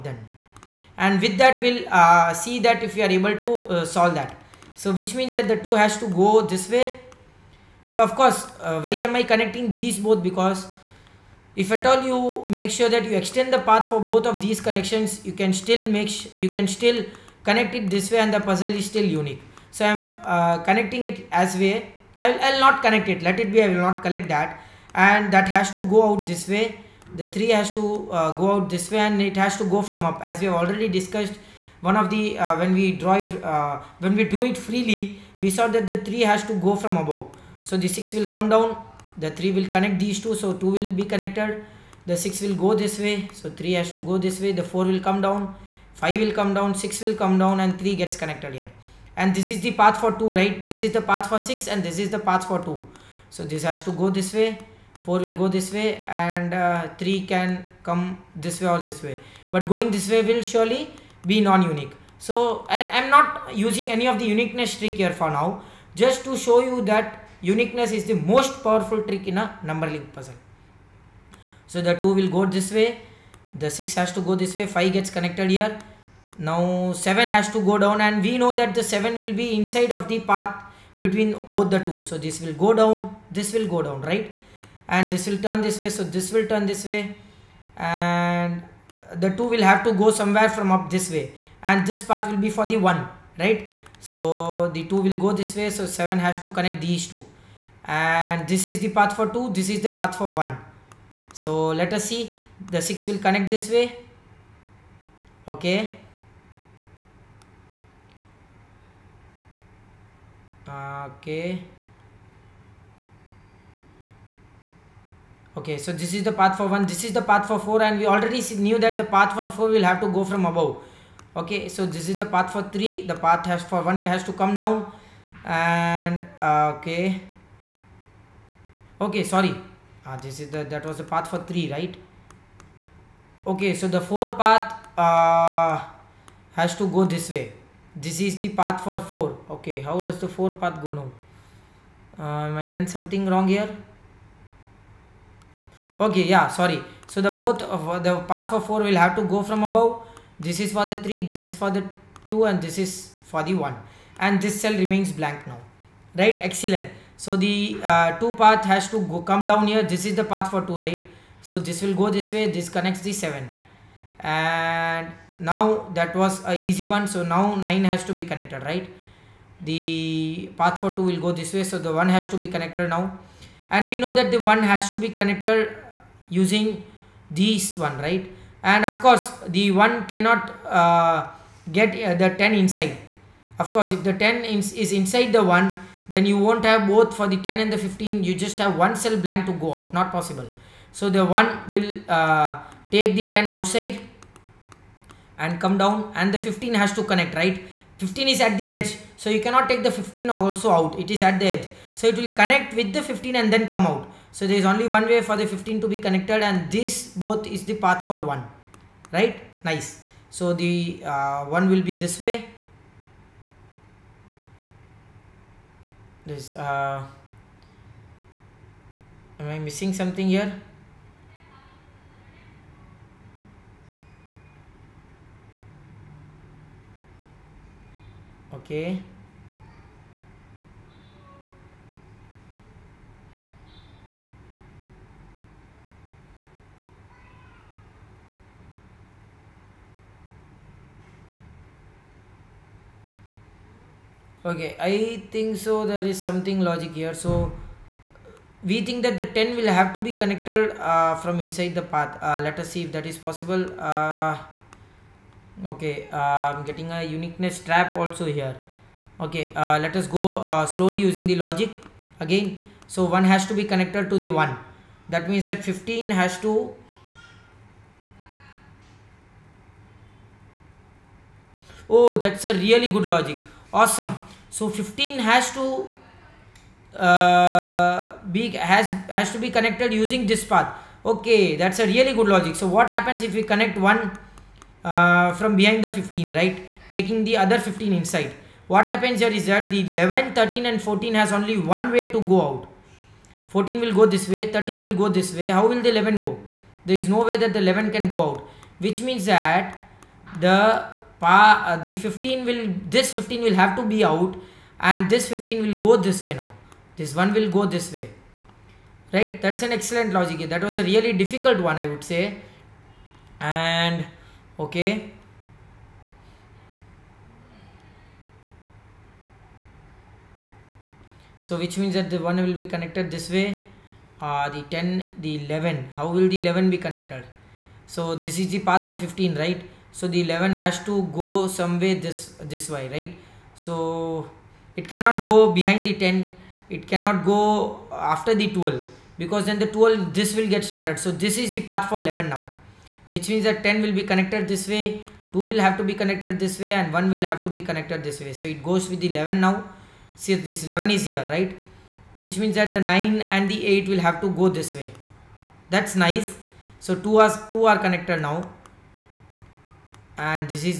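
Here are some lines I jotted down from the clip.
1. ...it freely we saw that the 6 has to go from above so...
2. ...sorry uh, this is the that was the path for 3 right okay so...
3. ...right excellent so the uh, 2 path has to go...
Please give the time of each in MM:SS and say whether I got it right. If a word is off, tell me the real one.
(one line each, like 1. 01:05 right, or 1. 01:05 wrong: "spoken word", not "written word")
1. 00:34 wrong: "3", not "6"
2. 02:09 right
3. 02:36 right.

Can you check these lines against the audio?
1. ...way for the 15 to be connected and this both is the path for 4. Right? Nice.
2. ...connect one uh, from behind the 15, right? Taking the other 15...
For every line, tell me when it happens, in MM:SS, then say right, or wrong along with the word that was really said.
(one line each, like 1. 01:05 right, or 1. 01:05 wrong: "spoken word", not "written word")
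1. 03:25 wrong: "1", not "4"
2. 04:43 right.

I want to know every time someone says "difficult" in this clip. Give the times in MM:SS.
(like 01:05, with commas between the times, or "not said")
05:11.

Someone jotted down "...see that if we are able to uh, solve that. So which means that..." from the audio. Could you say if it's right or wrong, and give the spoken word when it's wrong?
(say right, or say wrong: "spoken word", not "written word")
right.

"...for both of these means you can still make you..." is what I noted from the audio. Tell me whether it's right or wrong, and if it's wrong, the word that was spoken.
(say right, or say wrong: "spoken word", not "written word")
wrong: "connections", not "means".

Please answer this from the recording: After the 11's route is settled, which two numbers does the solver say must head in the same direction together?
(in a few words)
9 and 8.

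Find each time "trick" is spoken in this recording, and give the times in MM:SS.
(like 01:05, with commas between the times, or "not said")
01:04, 01:09.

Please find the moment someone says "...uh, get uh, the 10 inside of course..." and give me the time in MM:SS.
03:00.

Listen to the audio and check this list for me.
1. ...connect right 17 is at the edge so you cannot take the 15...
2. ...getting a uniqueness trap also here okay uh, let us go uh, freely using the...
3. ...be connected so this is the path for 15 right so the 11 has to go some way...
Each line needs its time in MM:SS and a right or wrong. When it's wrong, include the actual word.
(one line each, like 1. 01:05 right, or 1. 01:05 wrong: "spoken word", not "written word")
1. 03:17 wrong: "15", not "17"
2. 04:16 wrong: "slowly", not "freely"
3. 05:26 right.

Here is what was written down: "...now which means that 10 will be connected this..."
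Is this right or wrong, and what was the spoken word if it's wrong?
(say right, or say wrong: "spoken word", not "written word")
right.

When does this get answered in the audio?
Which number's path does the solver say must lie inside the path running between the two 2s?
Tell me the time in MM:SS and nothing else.
01:18.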